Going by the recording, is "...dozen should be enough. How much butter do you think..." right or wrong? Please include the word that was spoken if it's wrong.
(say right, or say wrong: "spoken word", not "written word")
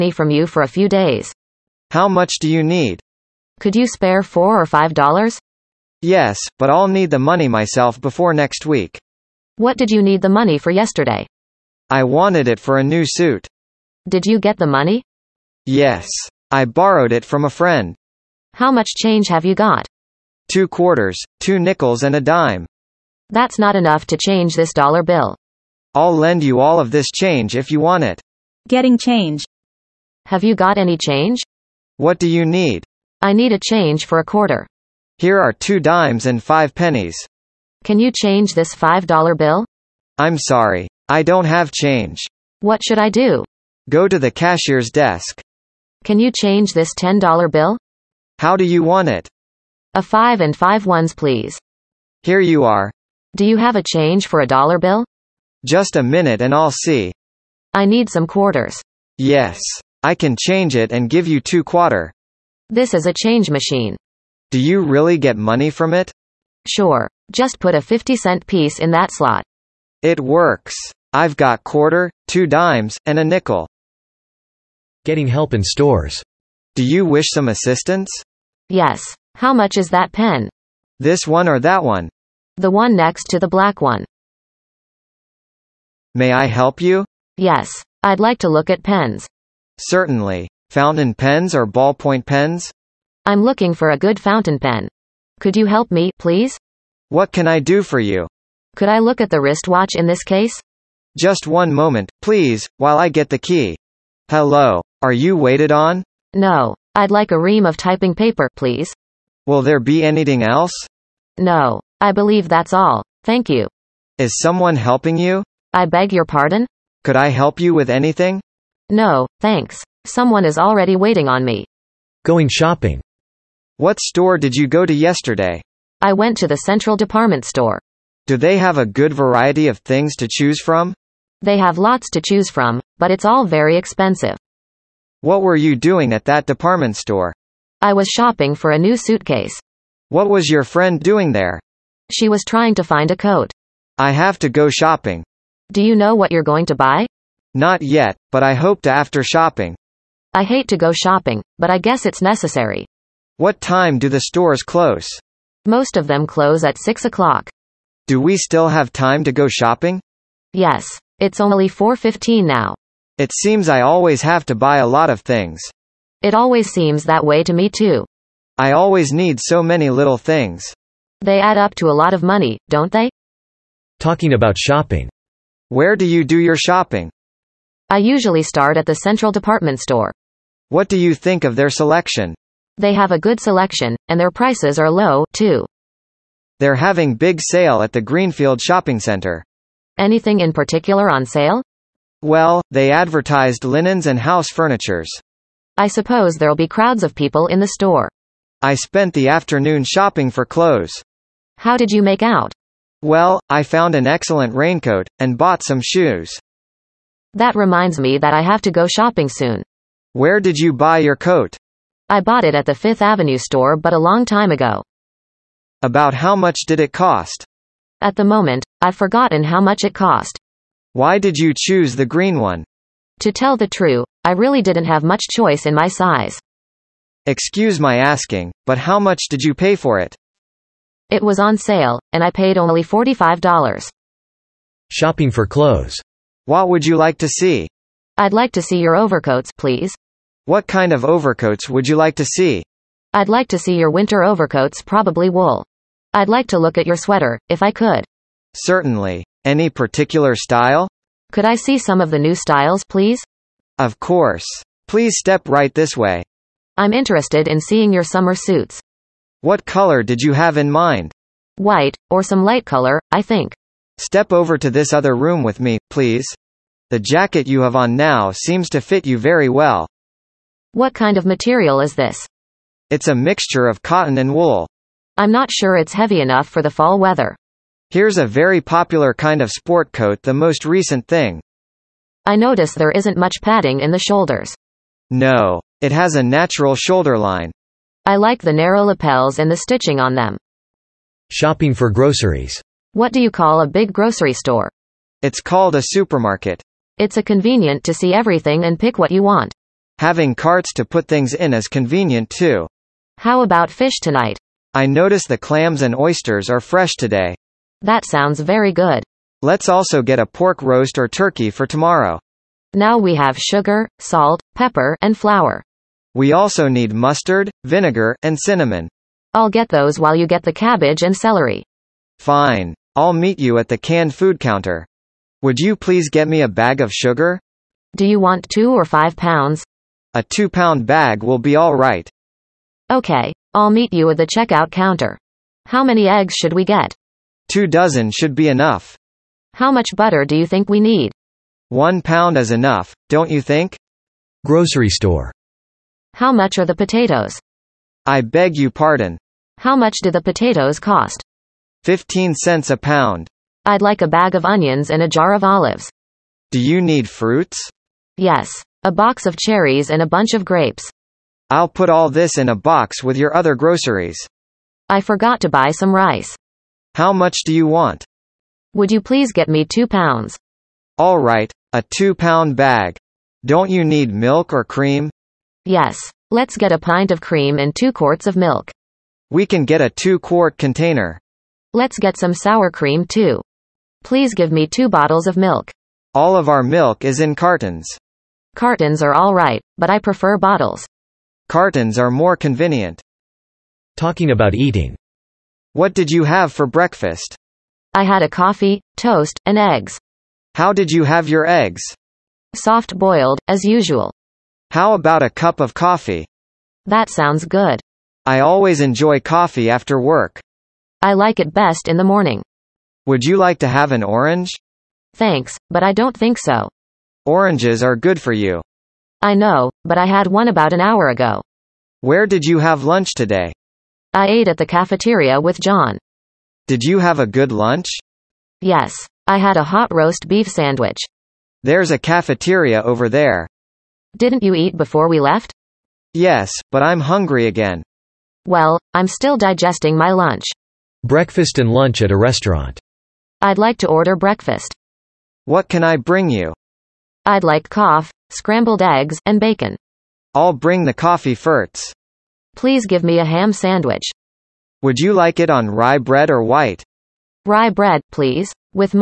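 right.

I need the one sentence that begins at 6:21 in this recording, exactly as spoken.
Let's get some sour cream too.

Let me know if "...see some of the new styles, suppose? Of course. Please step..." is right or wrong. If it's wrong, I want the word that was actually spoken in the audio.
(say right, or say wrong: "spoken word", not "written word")
wrong: "please", not "suppose".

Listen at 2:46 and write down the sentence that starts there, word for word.
It always seems that way to me too.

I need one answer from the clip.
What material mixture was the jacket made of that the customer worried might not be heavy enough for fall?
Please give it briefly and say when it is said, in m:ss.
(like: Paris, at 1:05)
cotton and wool, at 4:33.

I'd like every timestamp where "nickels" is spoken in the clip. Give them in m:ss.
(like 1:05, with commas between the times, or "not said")
0:21, 1:13.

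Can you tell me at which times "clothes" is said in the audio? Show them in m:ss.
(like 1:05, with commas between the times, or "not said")
3:20, 3:55.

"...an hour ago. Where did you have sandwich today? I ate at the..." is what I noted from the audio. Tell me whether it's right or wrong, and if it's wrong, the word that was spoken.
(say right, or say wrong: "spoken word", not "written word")
wrong: "lunch", not "sandwich".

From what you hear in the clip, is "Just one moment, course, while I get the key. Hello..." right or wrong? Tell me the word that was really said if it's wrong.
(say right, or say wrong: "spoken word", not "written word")
wrong: "please", not "course".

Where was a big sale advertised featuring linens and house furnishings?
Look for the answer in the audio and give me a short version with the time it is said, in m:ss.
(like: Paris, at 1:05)
Greenfield Shopping Center, at 3:07.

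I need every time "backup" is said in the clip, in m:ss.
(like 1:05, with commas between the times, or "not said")
not said.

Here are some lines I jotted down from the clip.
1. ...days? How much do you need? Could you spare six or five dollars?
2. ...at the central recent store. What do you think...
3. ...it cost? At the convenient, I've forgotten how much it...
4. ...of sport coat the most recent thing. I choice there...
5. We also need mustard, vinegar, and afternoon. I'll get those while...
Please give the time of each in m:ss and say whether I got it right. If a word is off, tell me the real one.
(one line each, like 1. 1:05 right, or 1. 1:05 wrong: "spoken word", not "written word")
1. 0:00 wrong: "four", not "six"
2. 2:58 wrong: "department", not "recent"
3. 3:36 wrong: "moment", not "convenient"
4. 4:39 wrong: "notice", not "choice"
5. 5:16 wrong: "cinnamon", not "afternoon".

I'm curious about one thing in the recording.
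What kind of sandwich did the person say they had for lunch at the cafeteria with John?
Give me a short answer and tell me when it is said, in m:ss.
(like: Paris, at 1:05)
hot roast beef sandwich, at 7:09.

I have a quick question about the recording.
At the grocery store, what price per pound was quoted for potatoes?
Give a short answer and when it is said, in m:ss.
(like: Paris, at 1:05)
15 cents, at 5:51.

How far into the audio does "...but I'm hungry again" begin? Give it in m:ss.
7:16.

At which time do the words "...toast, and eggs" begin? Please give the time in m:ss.
6:38.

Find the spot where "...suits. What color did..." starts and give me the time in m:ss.
4:18.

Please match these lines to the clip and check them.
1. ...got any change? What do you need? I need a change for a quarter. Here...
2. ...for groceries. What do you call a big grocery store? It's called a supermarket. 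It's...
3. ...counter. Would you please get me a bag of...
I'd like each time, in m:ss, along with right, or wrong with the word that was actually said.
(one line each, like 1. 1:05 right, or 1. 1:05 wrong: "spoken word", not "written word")
1. 0:30 right
2. 4:51 right
3. 5:24 right.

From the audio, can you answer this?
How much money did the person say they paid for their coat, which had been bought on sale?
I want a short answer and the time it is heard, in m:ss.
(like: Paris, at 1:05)
$45, at 3:52.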